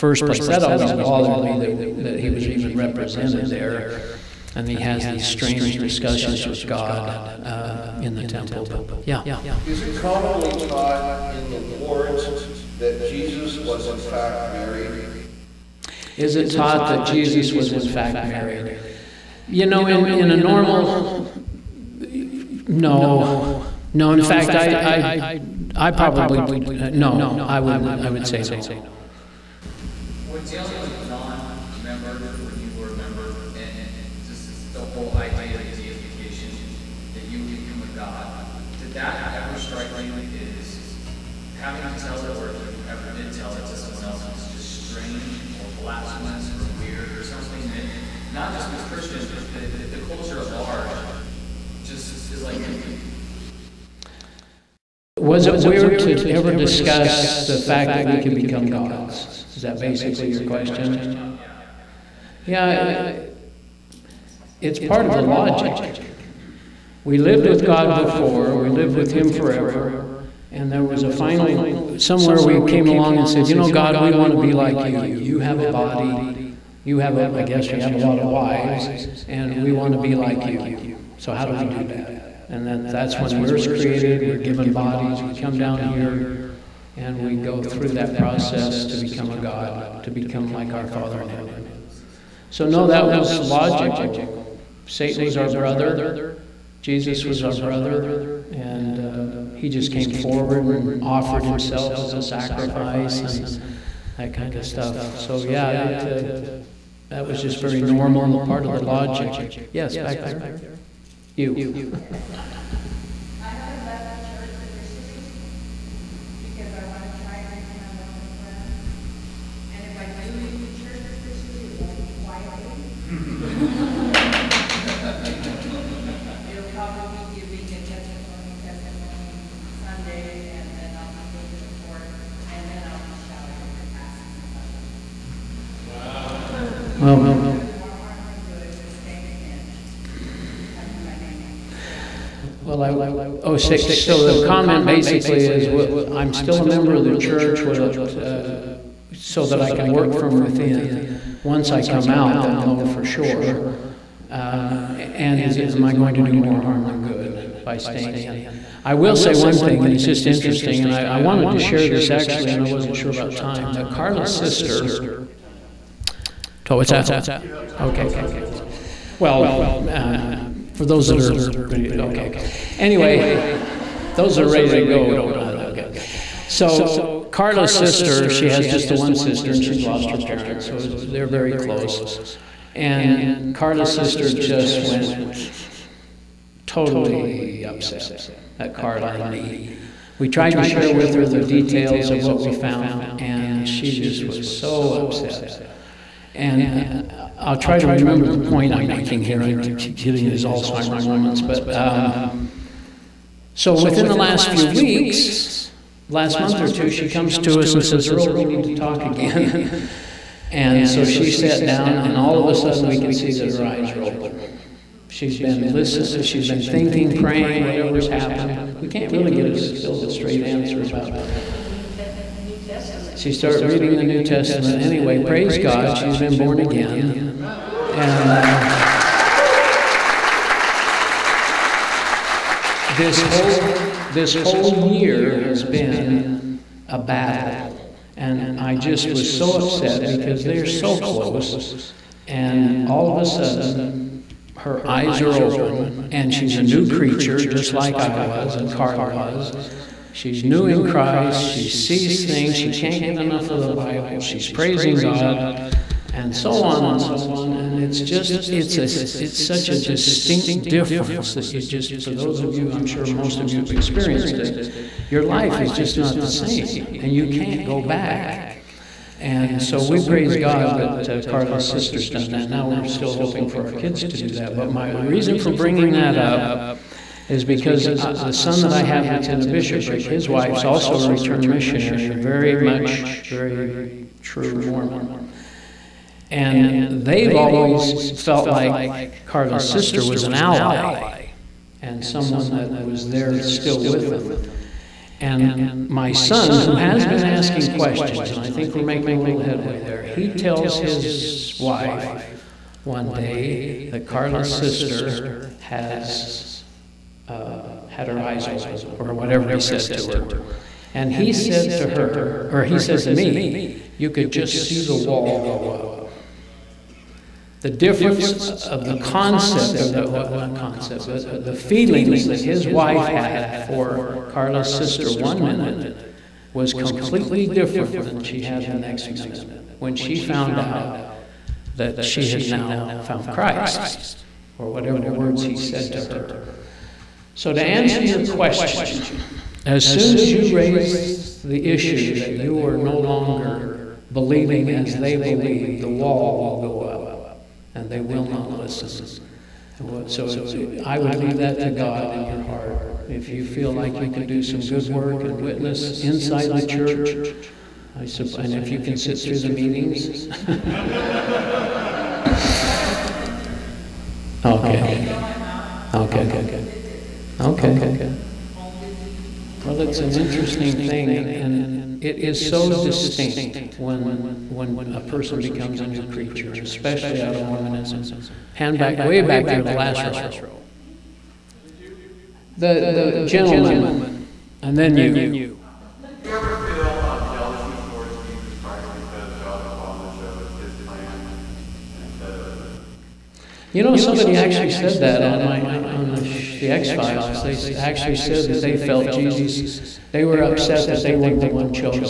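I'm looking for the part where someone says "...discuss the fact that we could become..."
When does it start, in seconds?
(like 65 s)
56 s.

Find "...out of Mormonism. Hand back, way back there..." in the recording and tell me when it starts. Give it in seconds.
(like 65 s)
377 s.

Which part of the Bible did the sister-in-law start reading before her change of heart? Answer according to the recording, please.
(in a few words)
New Testament.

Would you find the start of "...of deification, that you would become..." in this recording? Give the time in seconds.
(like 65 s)
35 s.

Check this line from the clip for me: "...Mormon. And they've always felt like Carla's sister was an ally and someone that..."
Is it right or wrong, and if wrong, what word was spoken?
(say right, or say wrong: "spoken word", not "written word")
right.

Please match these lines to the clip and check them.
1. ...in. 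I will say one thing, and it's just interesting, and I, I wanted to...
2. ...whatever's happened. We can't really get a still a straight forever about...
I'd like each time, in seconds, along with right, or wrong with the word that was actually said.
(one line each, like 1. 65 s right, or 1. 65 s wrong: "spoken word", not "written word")
1. 158 s right
2. 217 s wrong: "answer", not "forever".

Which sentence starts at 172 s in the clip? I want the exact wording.
Anyway, those are ready to go don't uh, okay.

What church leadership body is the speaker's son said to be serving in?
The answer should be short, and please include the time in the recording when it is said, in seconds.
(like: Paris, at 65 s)
bishopric, at 279 s.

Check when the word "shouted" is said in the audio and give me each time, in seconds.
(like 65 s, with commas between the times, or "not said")
133 s.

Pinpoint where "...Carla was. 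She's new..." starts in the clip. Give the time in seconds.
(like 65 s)
248 s.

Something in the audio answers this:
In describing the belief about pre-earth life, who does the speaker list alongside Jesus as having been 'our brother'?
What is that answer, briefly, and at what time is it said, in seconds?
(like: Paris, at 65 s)
Satan, at 94 s.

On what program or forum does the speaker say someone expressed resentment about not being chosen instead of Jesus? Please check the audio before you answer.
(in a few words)
The X Files.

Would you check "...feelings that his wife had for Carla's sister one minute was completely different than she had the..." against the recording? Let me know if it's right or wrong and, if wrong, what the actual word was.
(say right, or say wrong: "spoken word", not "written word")
right.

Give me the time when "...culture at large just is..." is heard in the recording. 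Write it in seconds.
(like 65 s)
50 s.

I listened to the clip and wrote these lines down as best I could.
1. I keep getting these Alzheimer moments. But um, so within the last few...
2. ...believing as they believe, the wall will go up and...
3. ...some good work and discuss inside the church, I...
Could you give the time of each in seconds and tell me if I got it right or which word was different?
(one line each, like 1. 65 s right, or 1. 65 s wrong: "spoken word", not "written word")
1. 199 s right
2. 344 s right
3. 354 s wrong: "witness", not "discuss".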